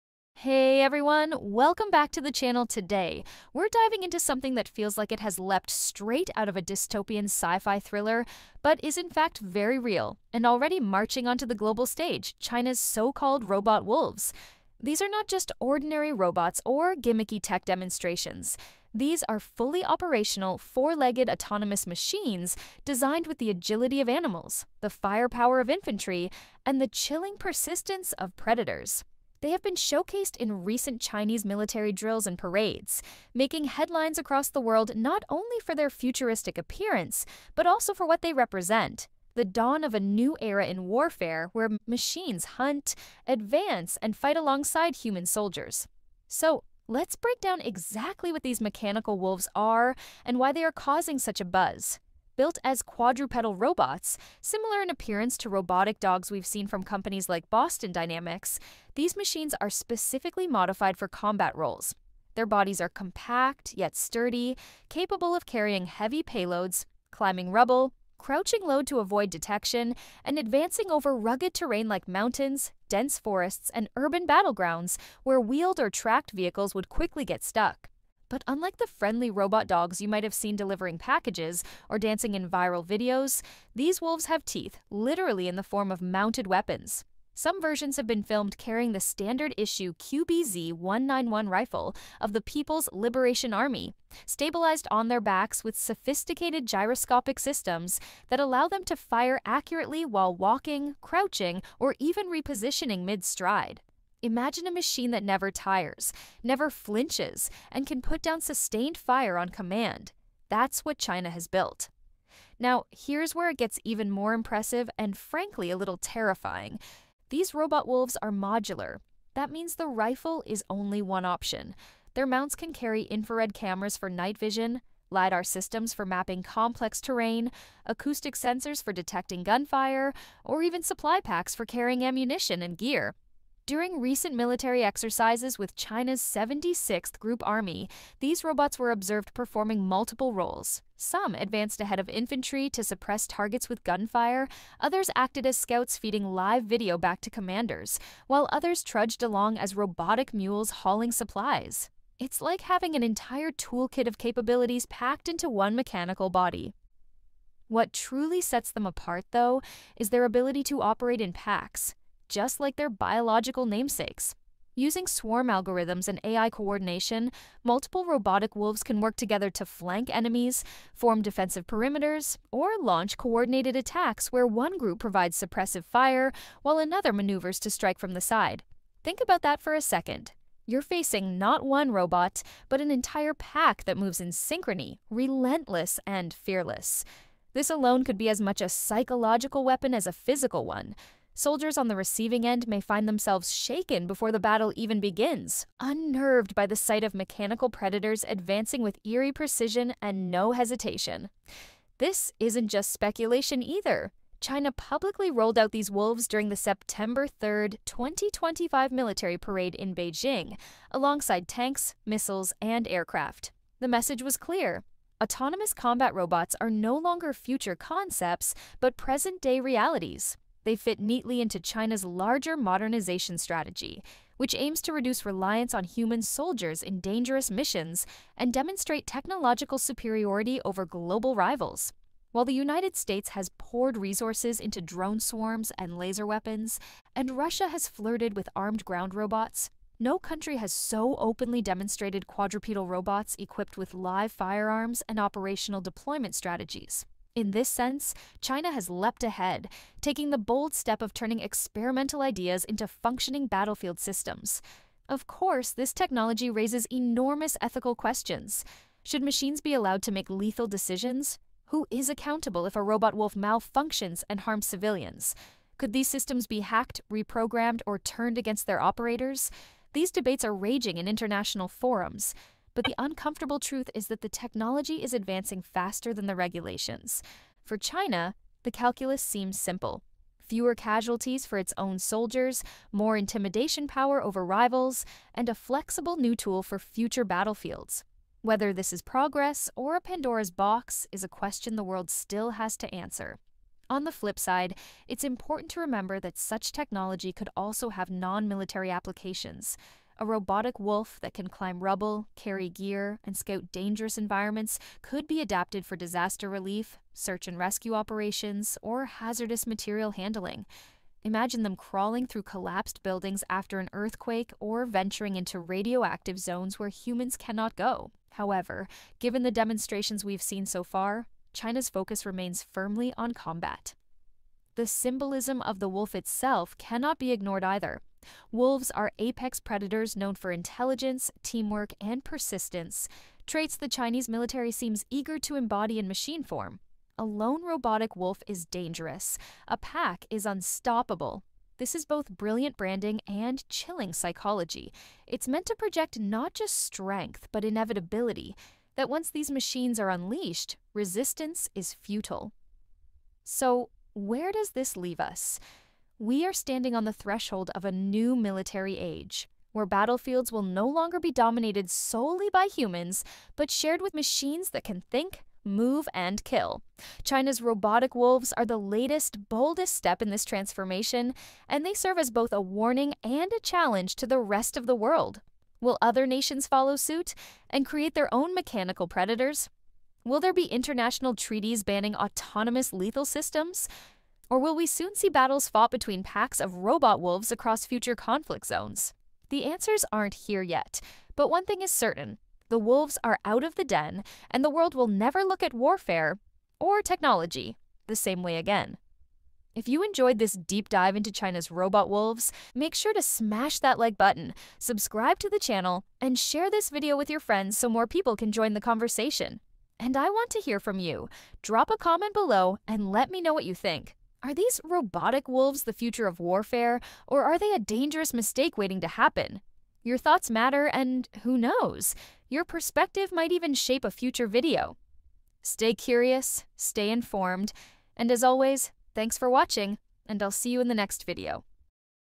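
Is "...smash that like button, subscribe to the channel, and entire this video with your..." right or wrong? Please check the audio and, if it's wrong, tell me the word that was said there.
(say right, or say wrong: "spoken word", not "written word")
wrong: "share", not "entire".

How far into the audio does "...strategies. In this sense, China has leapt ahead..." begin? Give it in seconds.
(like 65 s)
246 s.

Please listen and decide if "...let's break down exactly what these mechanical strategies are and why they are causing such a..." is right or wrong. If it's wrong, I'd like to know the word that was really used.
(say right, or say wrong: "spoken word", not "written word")
wrong: "wolves", not "strategies".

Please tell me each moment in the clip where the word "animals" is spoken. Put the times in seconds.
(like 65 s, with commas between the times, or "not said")
24 s.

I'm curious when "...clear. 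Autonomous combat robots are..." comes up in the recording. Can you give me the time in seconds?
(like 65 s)
214 s.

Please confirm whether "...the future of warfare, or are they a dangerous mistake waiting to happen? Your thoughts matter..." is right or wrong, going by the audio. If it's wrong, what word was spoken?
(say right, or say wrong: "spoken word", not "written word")
right.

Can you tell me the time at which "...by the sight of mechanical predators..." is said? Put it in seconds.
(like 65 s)
196 s.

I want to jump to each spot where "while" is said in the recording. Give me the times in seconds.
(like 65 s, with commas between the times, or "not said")
100 s, 148 s, 176 s, 232 s.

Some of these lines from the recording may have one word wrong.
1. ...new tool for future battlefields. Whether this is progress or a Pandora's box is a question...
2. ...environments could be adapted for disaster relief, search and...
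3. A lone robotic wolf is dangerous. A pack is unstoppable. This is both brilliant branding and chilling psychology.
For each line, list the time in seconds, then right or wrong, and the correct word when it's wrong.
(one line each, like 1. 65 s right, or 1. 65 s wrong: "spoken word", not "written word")
1. 286 s right
2. 304 s right
3. 337 s right.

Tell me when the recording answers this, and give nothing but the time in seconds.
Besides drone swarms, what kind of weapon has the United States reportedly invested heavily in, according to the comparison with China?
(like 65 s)
235 s.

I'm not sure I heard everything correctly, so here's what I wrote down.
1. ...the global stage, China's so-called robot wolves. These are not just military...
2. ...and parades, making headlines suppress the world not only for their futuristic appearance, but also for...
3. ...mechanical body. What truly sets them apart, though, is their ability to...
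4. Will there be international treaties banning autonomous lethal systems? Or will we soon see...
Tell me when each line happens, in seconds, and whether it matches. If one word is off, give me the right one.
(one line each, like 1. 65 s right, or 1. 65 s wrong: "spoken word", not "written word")
1. 11 s wrong: "ordinary", not "military"
2. 32 s wrong: "across", not "suppress"
3. 155 s right
4. 380 s right.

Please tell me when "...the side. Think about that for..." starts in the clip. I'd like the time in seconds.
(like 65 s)
178 s.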